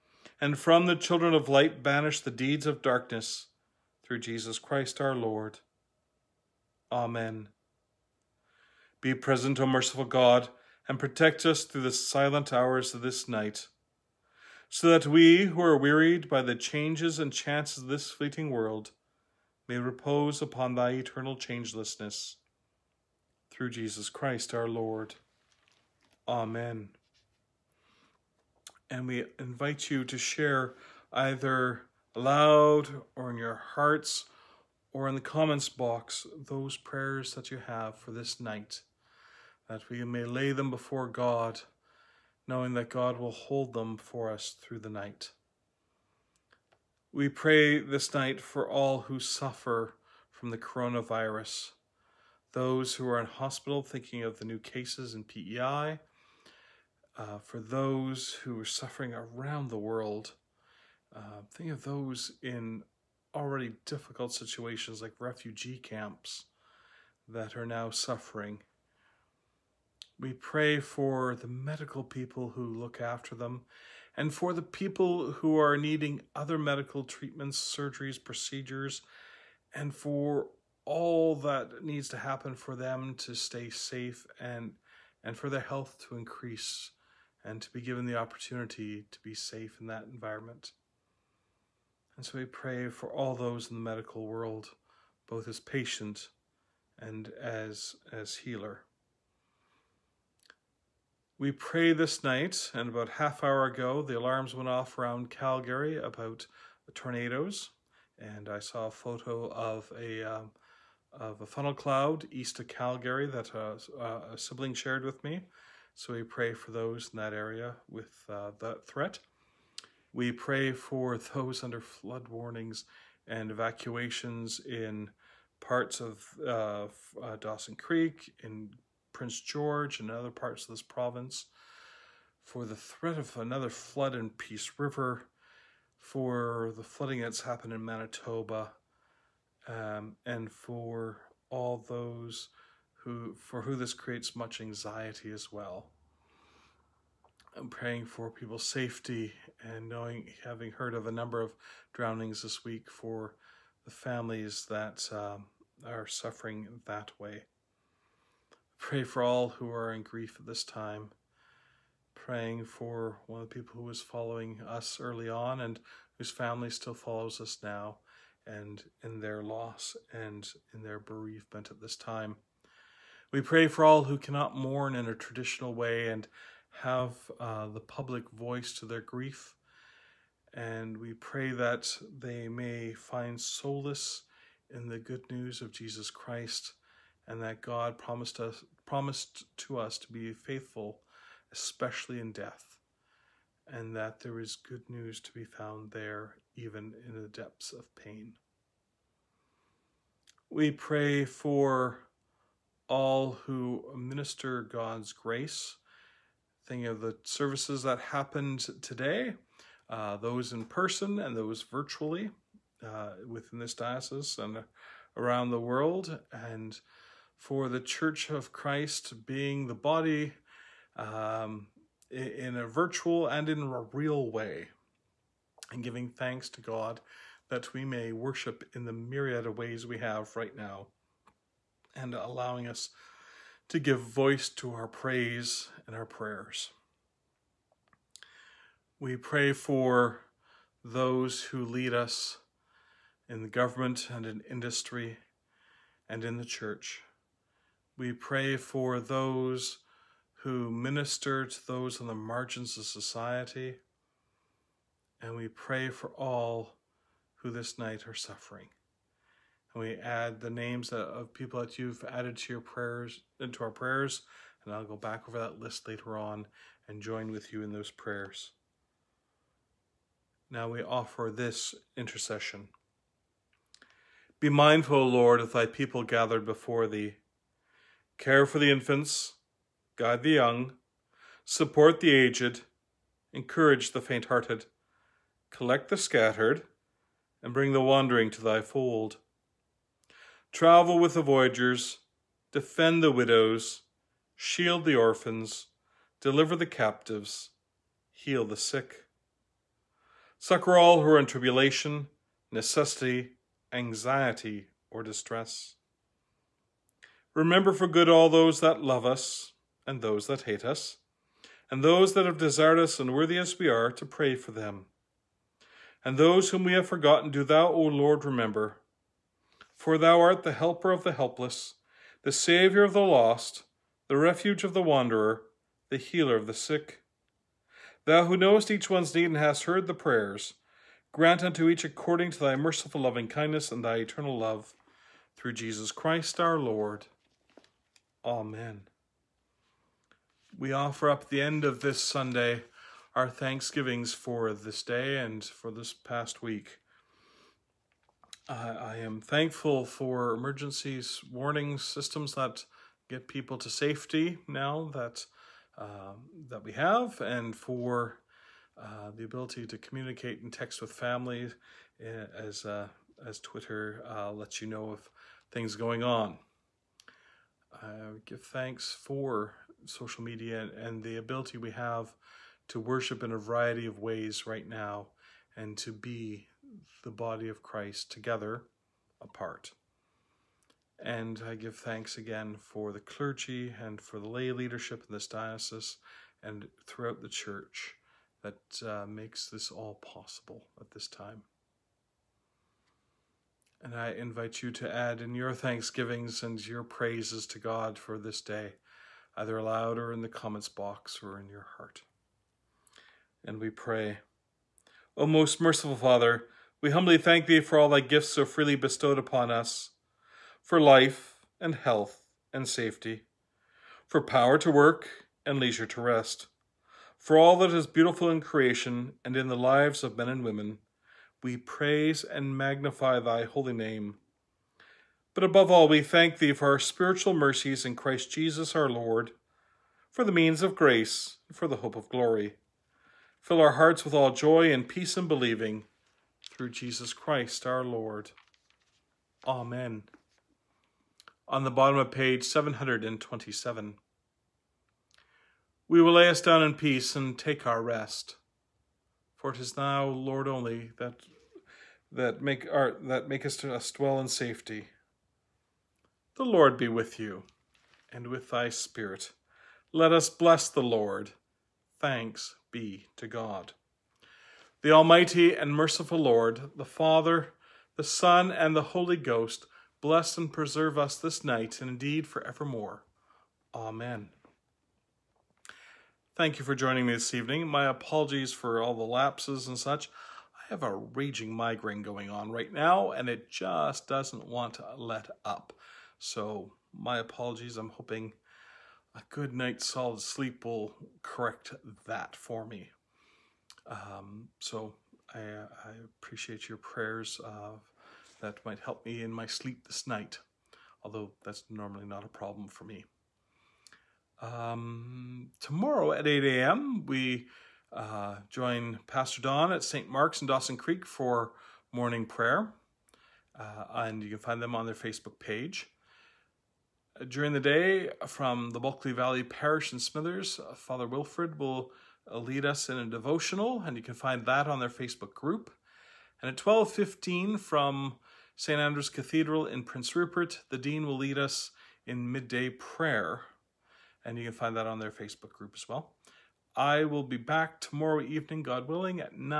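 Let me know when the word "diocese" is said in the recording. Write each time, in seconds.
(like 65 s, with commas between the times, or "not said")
213 s, 385 s.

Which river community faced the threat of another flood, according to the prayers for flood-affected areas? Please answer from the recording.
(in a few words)
Peace River.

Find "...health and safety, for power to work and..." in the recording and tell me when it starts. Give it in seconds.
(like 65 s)
411 s.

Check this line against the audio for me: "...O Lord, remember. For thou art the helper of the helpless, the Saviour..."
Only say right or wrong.
right.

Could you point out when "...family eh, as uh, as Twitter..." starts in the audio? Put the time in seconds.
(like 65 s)
360 s.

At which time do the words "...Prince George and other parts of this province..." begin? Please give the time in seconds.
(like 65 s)
129 s.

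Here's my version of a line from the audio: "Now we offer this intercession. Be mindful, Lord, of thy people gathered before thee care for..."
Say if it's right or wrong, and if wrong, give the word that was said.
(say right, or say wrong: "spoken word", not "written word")
right.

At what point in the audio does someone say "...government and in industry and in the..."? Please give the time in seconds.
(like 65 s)
243 s.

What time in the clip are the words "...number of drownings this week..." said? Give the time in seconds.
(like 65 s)
151 s.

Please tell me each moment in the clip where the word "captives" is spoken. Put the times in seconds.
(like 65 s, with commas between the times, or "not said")
296 s.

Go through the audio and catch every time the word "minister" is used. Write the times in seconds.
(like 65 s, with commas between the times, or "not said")
203 s, 250 s.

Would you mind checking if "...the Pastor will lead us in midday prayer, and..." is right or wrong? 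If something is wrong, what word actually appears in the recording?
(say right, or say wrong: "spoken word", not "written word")
wrong: "Dean", not "Pastor".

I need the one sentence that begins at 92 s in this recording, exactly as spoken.
And so we pray for all those in the medical world, both as patient and as as healer.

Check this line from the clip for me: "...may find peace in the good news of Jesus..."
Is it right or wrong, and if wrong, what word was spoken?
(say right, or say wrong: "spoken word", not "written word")
wrong: "solace", not "peace".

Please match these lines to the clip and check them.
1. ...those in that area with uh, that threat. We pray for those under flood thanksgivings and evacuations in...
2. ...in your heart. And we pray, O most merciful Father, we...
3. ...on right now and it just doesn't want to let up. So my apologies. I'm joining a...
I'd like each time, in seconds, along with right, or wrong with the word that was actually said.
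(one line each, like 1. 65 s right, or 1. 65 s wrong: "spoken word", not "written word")
1. 116 s wrong: "warnings", not "thanksgivings"
2. 401 s right
3. 482 s wrong: "hoping", not "joining".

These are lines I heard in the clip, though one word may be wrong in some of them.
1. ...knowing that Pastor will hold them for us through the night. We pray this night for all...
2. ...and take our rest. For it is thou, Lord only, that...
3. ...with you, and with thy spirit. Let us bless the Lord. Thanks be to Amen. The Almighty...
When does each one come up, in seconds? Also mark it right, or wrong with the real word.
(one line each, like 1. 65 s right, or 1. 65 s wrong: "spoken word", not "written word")
1. 42 s wrong: "God", not "Pastor"
2. 447 s right
3. 456 s wrong: "God", not "Amen".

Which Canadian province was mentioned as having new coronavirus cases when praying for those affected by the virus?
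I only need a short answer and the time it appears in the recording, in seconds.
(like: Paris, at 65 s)
PEI, at 55 s.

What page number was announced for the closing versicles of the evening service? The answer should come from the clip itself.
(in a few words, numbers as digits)
727.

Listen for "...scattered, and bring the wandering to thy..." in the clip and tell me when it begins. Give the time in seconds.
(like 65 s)
285 s.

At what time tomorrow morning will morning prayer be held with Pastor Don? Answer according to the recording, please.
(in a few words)
8 a.m.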